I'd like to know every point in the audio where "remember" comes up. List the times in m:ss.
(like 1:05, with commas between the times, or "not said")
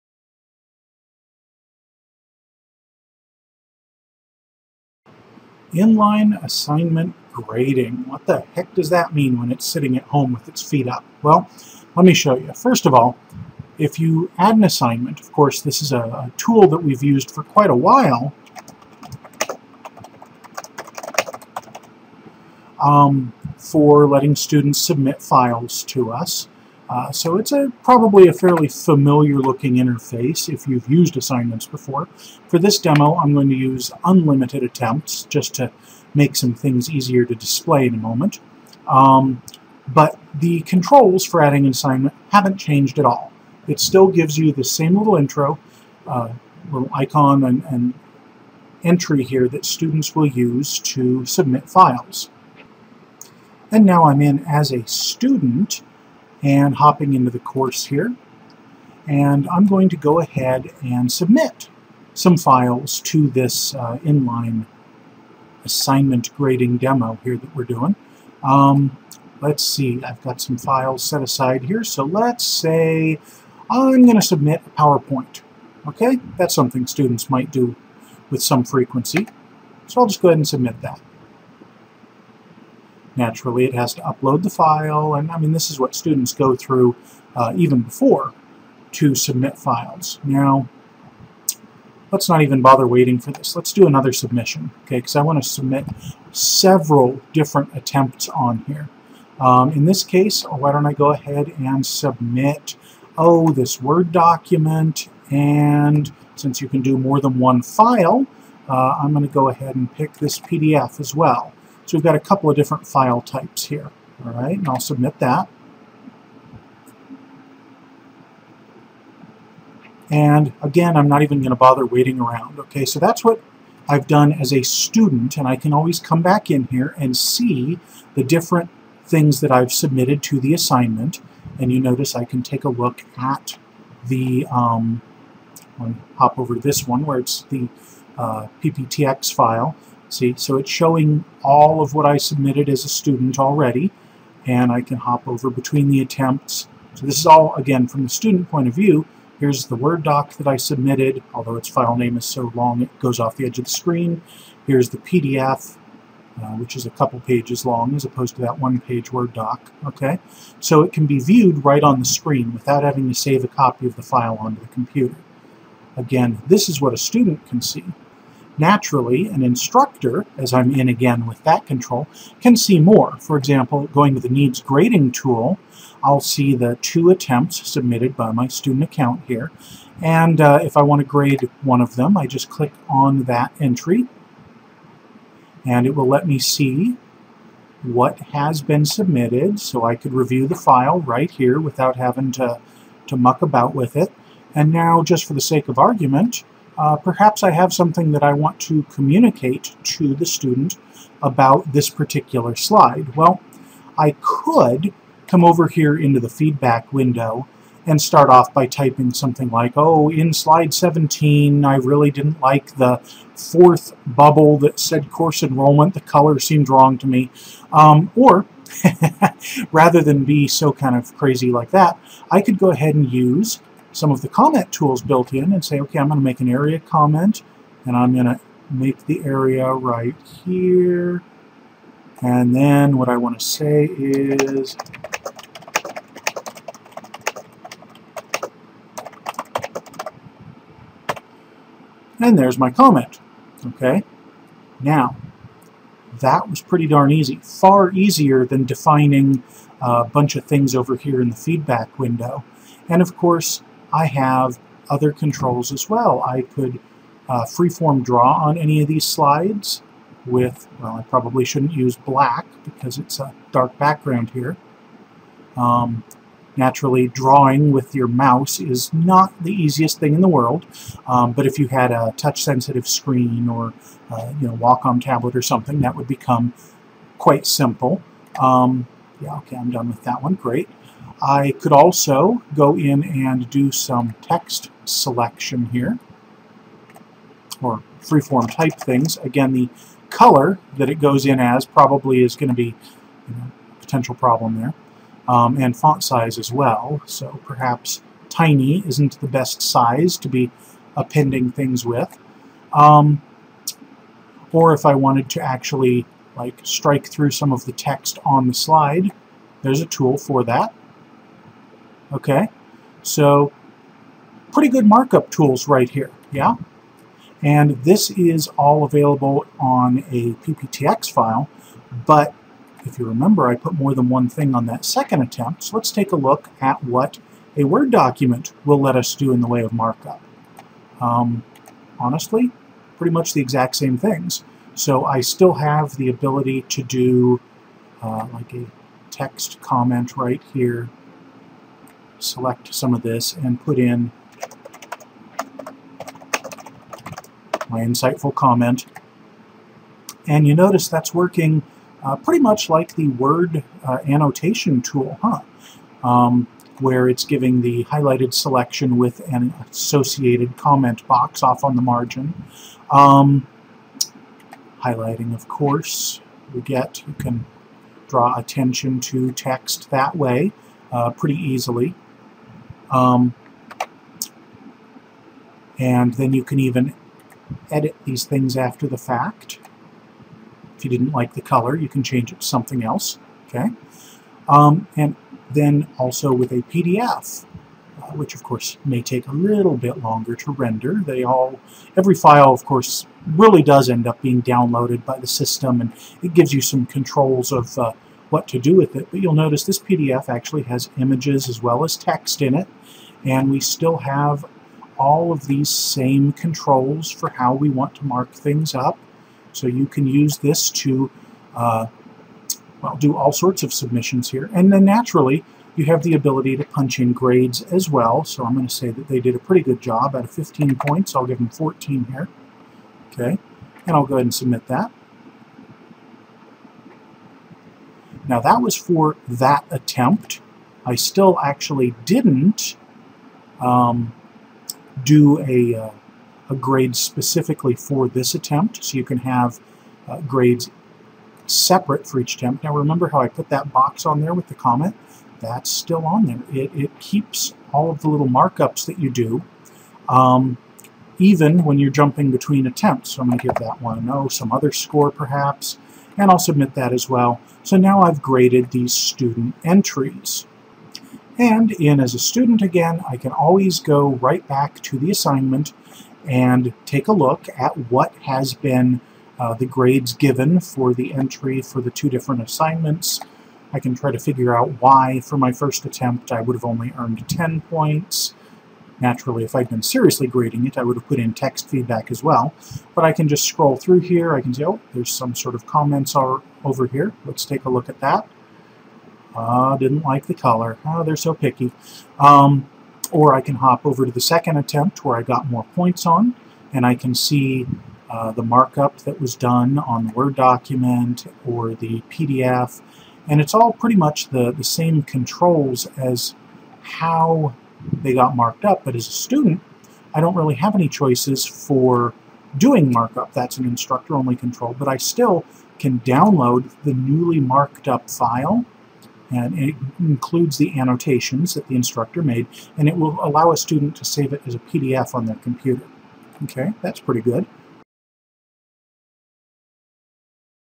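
5:23, 7:22.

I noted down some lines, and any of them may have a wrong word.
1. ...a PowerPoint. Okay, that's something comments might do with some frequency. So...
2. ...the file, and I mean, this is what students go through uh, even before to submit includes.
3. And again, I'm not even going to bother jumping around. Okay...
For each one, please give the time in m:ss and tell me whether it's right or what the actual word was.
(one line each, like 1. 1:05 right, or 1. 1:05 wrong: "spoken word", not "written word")
1. 1:14 wrong: "students", not "comments"
2. 1:24 wrong: "files", not "includes"
3. 2:00 wrong: "waiting", not "jumping".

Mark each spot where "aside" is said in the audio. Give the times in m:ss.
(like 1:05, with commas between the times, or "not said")
1:11.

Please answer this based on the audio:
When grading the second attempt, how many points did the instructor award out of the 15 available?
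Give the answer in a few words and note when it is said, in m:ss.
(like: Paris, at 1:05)
14, at 7:01.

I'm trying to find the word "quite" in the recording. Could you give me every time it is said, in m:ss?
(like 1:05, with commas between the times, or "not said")
0:17, 4:37.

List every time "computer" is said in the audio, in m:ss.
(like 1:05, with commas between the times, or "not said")
2:44, 8:45.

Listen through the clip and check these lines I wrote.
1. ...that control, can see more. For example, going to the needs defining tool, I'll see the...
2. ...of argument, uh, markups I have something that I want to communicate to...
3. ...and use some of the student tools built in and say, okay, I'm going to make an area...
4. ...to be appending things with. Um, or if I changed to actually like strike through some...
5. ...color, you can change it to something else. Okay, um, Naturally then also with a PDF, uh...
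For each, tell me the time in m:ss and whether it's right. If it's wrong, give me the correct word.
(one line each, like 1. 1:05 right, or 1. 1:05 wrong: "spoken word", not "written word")
1. 2:51 wrong: "grading", not "defining"
2. 3:15 wrong: "perhaps", not "markups"
3. 3:42 wrong: "comment", not "student"
4. 5:00 wrong: "wanted", not "changed"
5. 6:21 wrong: "And", not "Naturally".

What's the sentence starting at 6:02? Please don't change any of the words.
Um, highlighting, of course, we get, you can draw attention to text that way uh, pretty easily.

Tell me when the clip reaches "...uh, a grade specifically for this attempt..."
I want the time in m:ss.
7:15.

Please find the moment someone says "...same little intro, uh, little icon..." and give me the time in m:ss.
0:44.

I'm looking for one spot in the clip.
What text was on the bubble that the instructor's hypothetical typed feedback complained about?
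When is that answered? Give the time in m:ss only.
3:35.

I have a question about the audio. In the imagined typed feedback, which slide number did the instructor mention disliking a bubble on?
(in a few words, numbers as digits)
17.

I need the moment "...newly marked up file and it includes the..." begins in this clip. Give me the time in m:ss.
8:36.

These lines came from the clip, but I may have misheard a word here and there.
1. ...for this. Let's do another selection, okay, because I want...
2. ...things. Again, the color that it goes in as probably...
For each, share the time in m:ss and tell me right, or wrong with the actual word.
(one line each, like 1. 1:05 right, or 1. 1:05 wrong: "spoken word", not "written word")
1. 1:33 wrong: "submission", not "selection"
2. 4:48 right.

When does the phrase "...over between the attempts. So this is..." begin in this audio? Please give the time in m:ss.
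2:25.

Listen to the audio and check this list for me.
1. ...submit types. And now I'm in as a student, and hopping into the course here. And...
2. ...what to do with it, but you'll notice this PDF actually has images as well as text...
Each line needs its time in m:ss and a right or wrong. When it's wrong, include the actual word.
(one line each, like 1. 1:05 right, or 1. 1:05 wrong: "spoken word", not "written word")
1. 0:51 wrong: "files", not "types"
2. 6:38 right.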